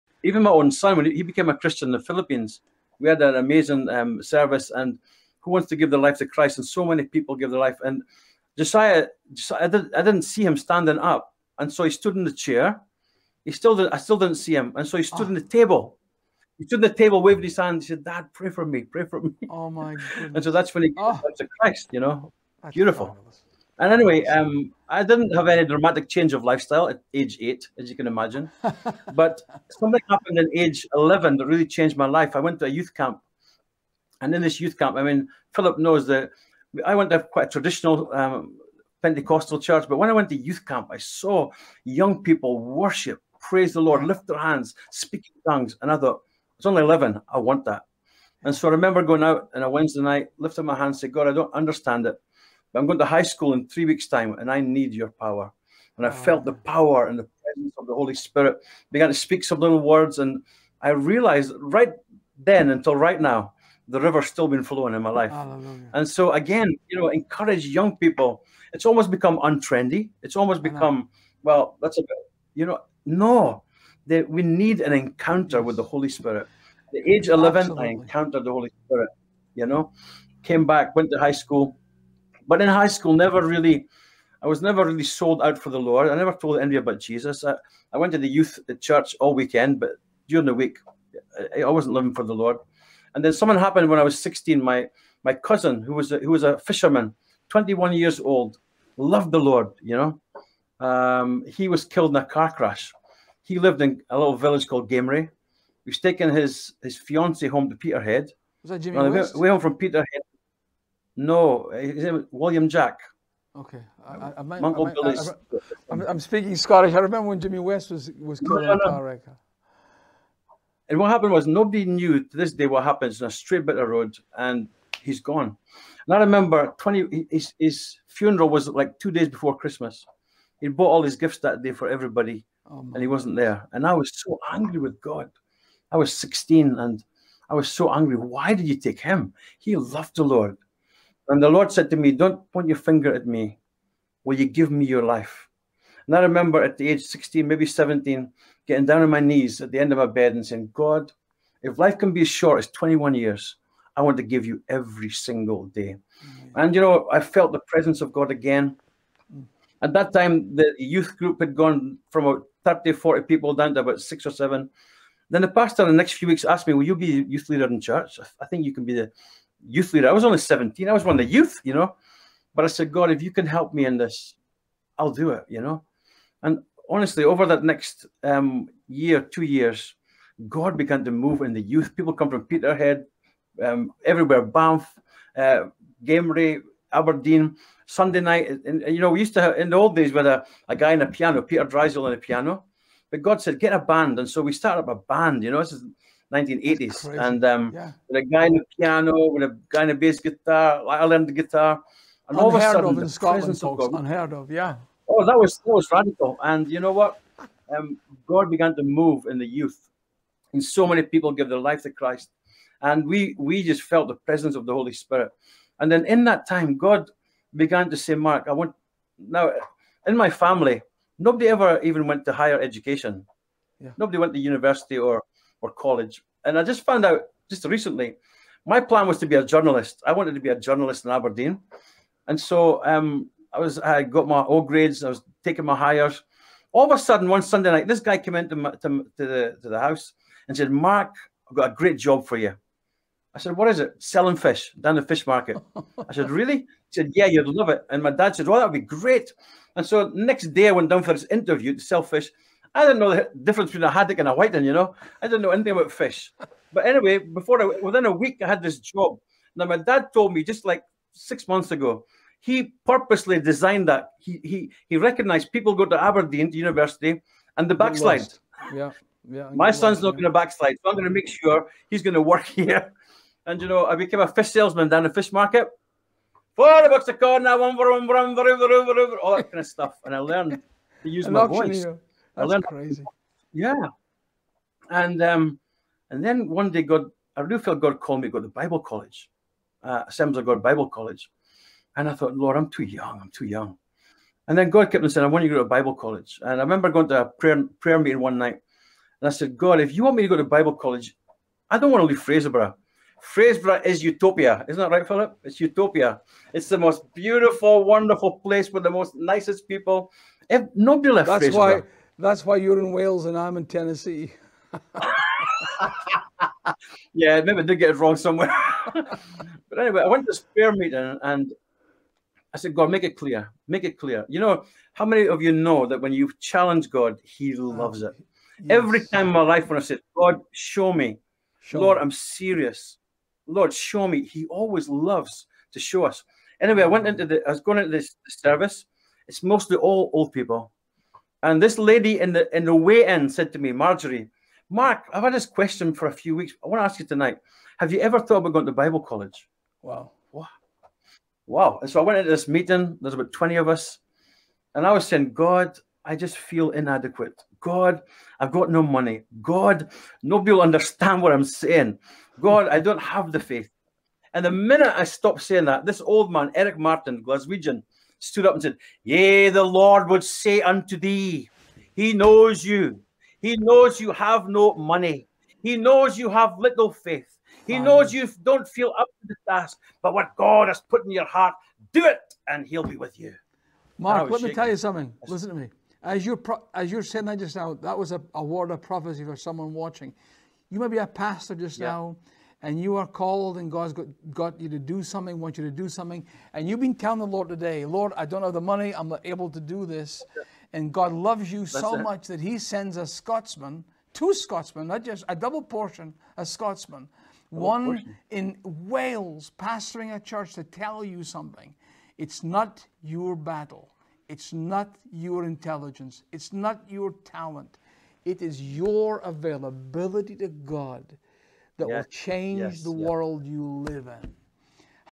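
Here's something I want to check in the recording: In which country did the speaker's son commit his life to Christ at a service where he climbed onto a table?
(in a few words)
Philippines.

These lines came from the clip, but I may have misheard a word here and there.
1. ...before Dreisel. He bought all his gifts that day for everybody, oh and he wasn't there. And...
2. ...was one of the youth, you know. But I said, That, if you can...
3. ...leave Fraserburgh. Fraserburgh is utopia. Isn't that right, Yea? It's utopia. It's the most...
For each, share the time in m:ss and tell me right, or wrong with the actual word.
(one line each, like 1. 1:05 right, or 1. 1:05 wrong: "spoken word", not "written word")
1. 2:09 wrong: "Christmas", not "Dreisel"
2. 2:50 wrong: "God", not "That"
3. 5:02 wrong: "Philip", not "Yea".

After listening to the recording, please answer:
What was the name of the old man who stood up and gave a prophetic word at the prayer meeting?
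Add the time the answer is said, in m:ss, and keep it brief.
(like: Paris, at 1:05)
Eric Martin, at 6:06.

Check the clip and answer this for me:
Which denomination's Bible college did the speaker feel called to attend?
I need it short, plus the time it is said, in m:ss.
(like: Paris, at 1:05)
Assemblies of God, at 4:50.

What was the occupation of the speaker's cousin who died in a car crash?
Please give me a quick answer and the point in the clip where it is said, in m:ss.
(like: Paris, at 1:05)
Fisherman, at 1:36.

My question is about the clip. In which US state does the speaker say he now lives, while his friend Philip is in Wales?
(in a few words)
Tennessee.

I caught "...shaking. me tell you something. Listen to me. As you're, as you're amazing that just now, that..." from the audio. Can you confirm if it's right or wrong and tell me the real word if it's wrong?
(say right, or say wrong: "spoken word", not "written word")
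wrong: "saying", not "amazing".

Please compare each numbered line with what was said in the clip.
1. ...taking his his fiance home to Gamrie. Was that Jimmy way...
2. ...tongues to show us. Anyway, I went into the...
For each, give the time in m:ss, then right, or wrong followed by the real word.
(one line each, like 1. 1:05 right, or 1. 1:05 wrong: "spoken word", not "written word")
1. 1:45 wrong: "Peterhead", not "Gamrie"
2. 5:34 wrong: "loves", not "tongues".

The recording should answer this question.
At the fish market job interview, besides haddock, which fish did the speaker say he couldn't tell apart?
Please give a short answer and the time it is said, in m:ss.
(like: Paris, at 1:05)
Whiting, at 4:14.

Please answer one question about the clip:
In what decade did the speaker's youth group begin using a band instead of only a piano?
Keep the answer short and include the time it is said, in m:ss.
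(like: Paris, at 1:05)
1980s, at 3:16.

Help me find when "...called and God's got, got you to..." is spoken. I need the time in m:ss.
6:33.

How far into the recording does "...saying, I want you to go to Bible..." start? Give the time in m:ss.
4:55.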